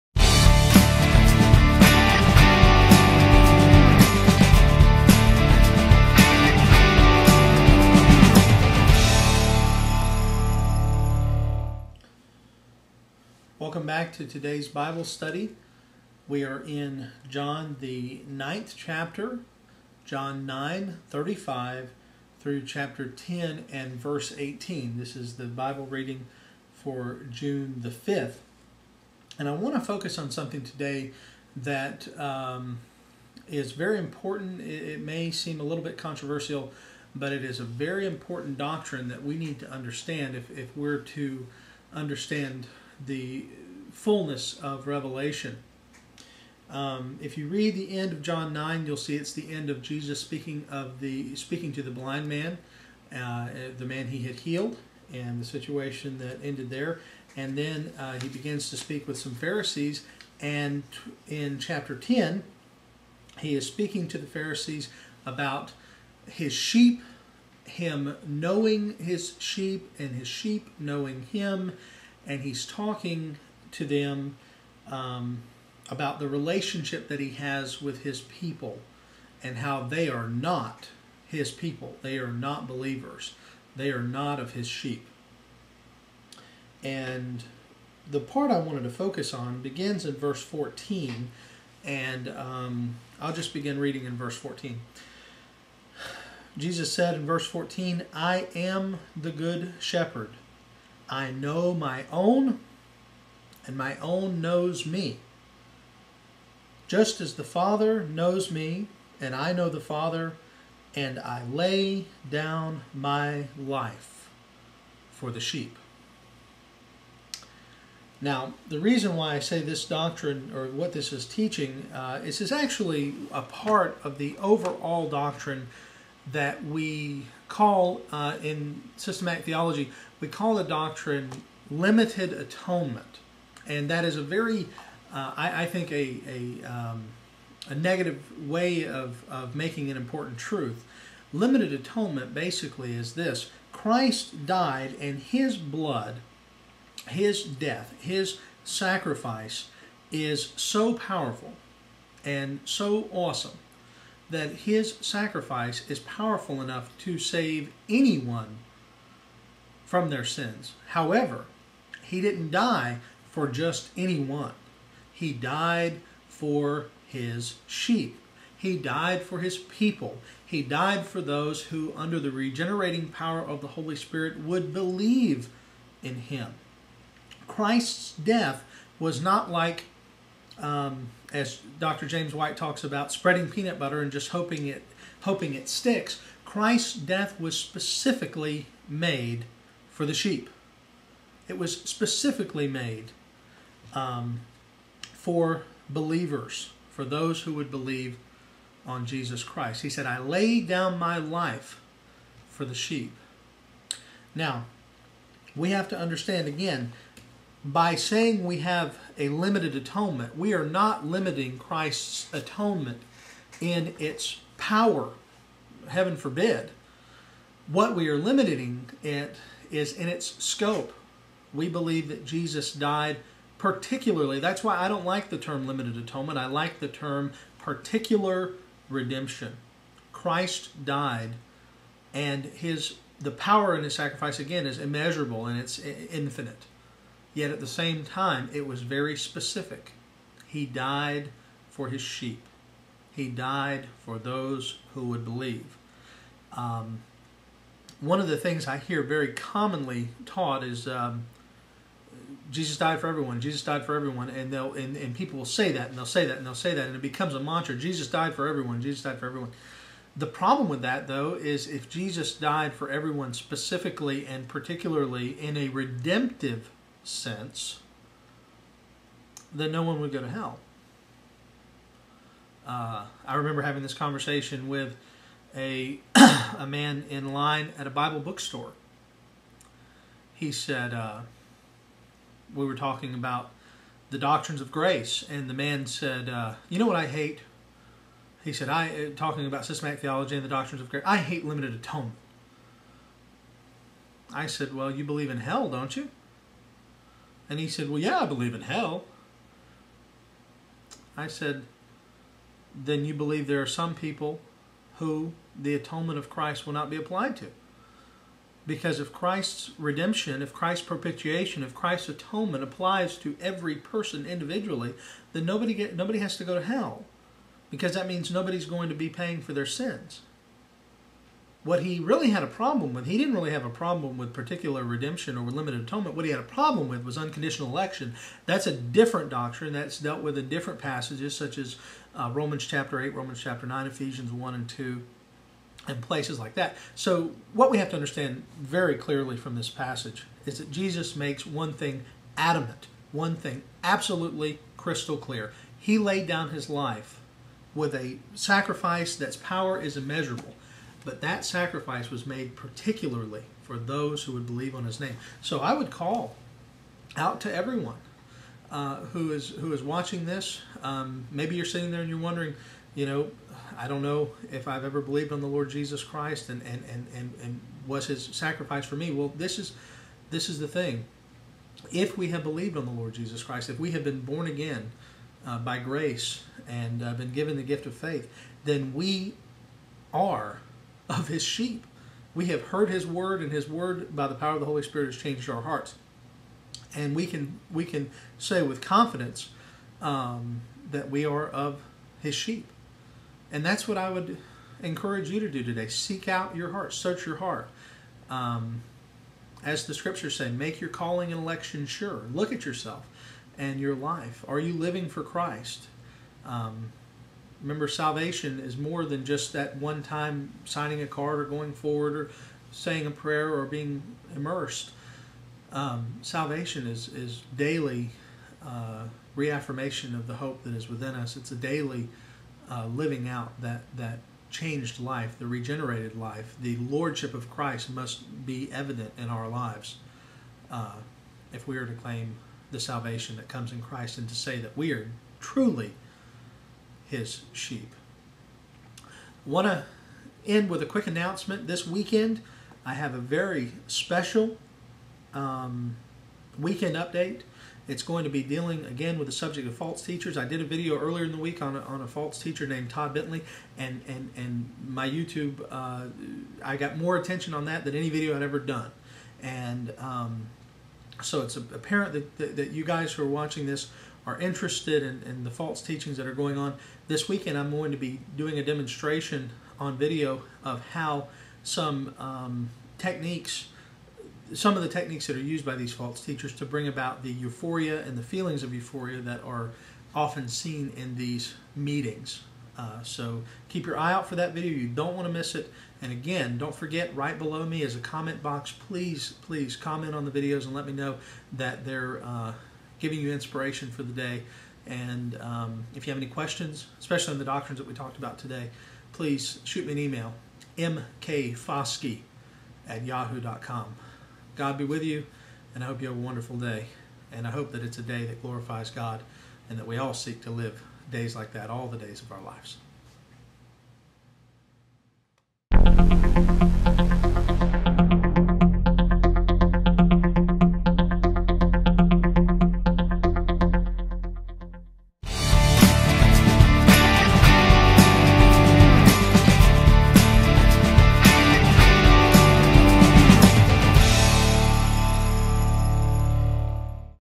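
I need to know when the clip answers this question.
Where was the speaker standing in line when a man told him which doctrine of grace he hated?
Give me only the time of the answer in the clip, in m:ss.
4:37.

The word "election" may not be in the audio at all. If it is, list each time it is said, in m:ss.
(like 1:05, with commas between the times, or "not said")
5:27, 6:41.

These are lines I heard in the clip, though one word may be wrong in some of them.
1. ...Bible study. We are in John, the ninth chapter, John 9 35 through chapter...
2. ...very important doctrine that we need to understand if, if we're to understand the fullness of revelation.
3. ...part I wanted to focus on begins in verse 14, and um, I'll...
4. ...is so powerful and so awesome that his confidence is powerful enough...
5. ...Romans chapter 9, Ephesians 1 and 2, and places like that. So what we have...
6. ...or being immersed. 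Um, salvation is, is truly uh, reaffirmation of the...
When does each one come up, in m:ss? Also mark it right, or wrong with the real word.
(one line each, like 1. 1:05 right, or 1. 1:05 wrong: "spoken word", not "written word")
1. 0:14 right
2. 0:37 right
3. 1:28 right
4. 2:30 wrong: "sacrifice", not "confidence"
5. 5:33 right
6. 6:53 wrong: "daily", not "truly".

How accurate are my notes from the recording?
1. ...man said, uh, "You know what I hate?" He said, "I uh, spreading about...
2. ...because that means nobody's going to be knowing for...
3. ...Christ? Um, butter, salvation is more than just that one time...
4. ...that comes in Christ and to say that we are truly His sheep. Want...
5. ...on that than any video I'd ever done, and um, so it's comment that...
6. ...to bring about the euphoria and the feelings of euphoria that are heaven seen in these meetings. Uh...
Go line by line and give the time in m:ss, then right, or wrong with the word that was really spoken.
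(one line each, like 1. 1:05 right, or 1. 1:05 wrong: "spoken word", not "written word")
1. 4:45 wrong: "talking", not "spreading"
2. 5:17 wrong: "paying", not "knowing"
3. 6:45 wrong: "remember", not "butter"
4. 7:13 right
5. 7:37 wrong: "apparent", not "comment"
6. 7:56 wrong: "often", not "heaven".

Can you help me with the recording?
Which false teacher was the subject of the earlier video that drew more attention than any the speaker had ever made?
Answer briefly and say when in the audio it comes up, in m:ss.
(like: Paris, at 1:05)
Todd Bentley, at 7:32.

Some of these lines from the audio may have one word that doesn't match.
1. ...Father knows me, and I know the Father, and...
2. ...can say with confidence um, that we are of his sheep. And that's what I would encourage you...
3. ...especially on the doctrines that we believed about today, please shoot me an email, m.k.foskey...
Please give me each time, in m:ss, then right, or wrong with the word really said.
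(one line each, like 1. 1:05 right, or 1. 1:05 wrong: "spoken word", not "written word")
1. 1:47 right
2. 6:27 right
3. 8:16 wrong: "talked", not "believed".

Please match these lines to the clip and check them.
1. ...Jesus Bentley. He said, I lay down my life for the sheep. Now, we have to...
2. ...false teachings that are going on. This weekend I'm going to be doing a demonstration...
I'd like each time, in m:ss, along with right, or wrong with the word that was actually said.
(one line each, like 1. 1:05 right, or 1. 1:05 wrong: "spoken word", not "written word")
1. 3:19 wrong: "Christ", not "Bentley"
2. 7:45 right.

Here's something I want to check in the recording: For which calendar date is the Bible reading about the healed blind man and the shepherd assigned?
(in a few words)
June 5th.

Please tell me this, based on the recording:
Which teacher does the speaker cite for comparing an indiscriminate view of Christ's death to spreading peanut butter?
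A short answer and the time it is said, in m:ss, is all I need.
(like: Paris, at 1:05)
Dr. James White, at 3:01.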